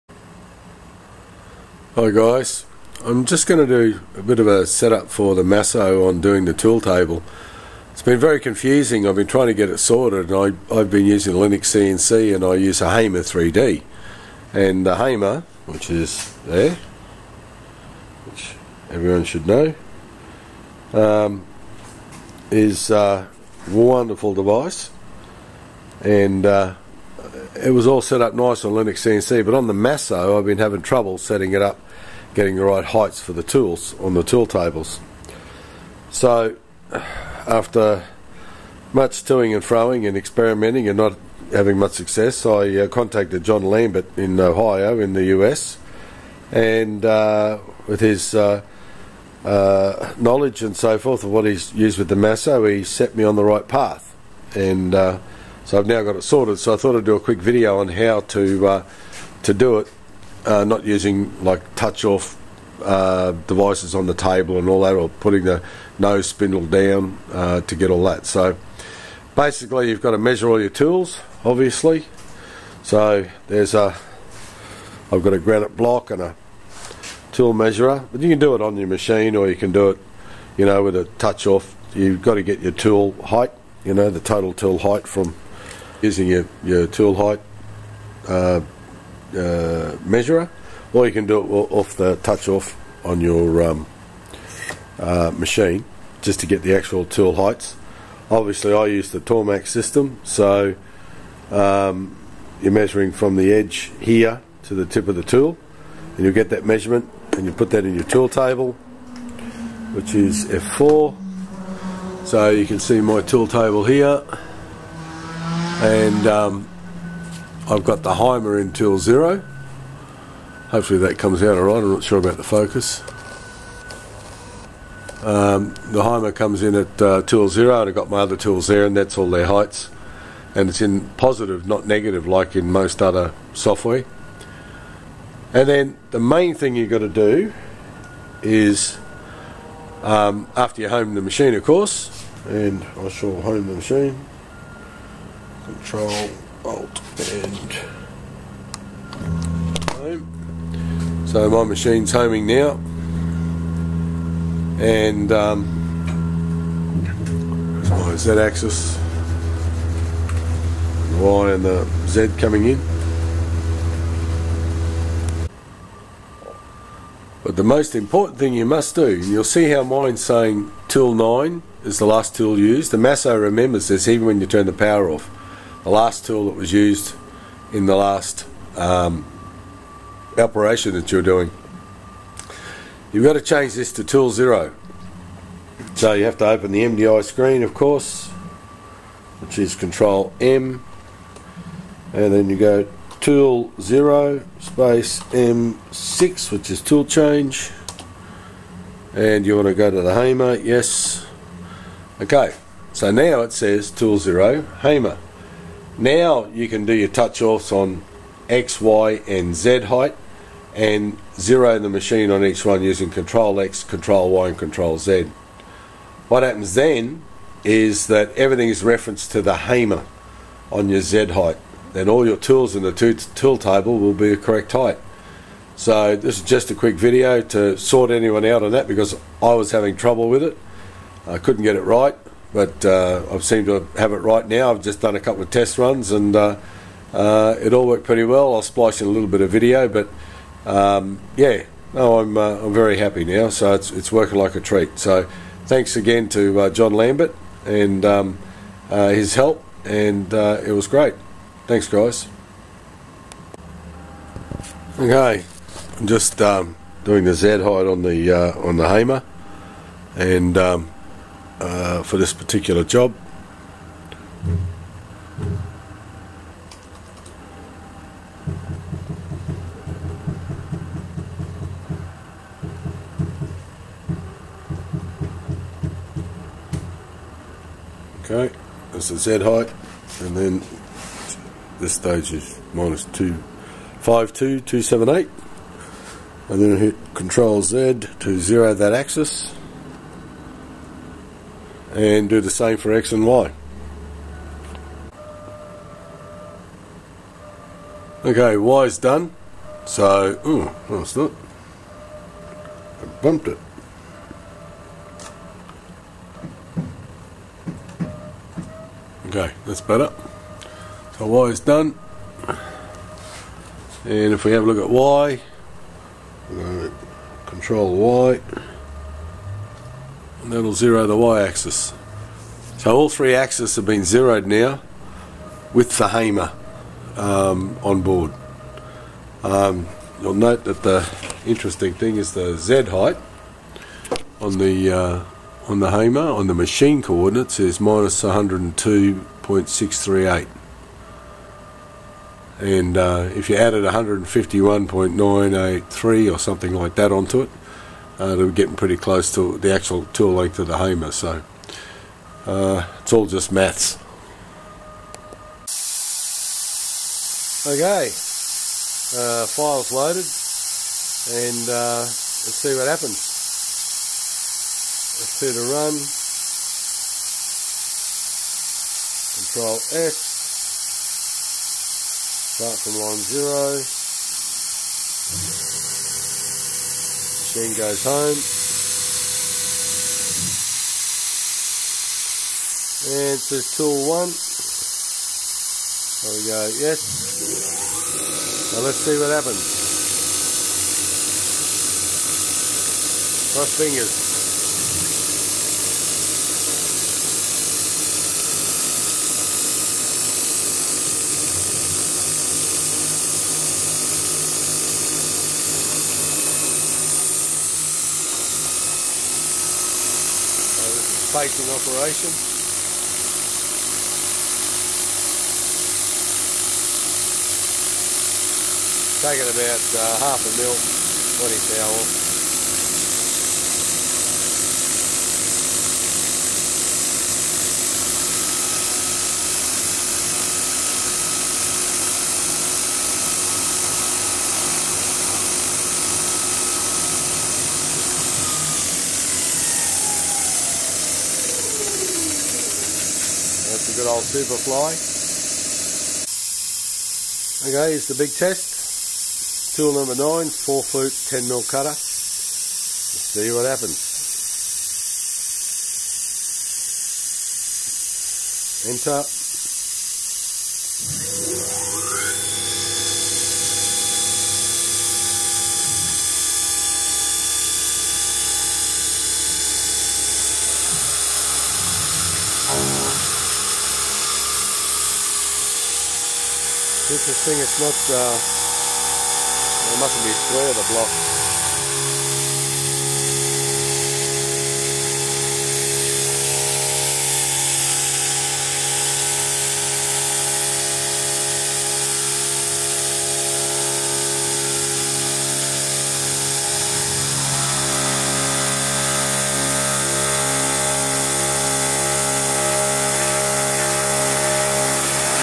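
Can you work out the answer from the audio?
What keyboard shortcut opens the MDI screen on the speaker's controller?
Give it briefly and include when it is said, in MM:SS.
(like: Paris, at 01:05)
Control M, at 03:09.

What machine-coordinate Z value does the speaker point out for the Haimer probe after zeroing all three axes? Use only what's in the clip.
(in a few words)
-102.638.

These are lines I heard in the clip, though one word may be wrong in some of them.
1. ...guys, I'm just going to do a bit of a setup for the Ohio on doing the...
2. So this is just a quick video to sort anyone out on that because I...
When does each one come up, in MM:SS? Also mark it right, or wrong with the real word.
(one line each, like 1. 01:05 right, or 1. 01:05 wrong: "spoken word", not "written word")
1. 00:02 wrong: "Masso", not "Ohio"
2. 03:45 right.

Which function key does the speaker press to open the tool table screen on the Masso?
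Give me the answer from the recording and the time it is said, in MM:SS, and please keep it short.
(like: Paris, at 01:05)
F4, at 01:50.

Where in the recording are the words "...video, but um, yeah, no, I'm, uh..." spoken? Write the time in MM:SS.
03:59.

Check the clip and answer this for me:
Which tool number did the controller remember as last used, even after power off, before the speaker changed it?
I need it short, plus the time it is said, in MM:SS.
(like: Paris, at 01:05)
9, at 02:50.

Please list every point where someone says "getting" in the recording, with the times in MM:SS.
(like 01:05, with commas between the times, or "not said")
00:32, 05:48.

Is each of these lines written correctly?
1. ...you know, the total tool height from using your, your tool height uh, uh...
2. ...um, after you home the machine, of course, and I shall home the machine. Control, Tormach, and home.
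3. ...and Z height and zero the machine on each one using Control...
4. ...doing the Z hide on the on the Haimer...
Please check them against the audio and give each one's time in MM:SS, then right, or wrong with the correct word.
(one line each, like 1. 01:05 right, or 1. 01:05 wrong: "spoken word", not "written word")
1. 01:23 right
2. 02:20 wrong: "Alt", not "Tormach"
3. 03:29 right
4. 04:17 right.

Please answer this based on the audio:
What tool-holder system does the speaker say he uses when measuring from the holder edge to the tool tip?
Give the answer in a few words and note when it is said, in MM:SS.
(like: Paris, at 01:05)
Tormach, at 01:39.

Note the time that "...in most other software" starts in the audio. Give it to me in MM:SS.
02:12.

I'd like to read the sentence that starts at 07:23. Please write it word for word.
That's a good old super fly.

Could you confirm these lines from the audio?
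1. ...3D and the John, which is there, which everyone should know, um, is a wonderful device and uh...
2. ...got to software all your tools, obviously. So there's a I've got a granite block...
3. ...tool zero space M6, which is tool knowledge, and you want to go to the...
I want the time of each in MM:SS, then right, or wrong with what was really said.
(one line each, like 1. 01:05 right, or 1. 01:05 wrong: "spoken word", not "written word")
1. 00:13 wrong: "Haimer", not "John"
2. 01:10 wrong: "measure", not "software"
3. 03:13 wrong: "change", not "knowledge".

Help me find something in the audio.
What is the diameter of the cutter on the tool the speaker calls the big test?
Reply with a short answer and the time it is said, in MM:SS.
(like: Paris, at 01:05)
10 mil, at 07:31.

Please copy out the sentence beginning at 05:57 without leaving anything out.
Okay, uh, file's loaded, and uh, let's see what happens.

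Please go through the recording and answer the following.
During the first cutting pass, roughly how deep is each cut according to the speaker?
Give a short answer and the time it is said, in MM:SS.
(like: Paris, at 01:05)
half a mil, at 07:00.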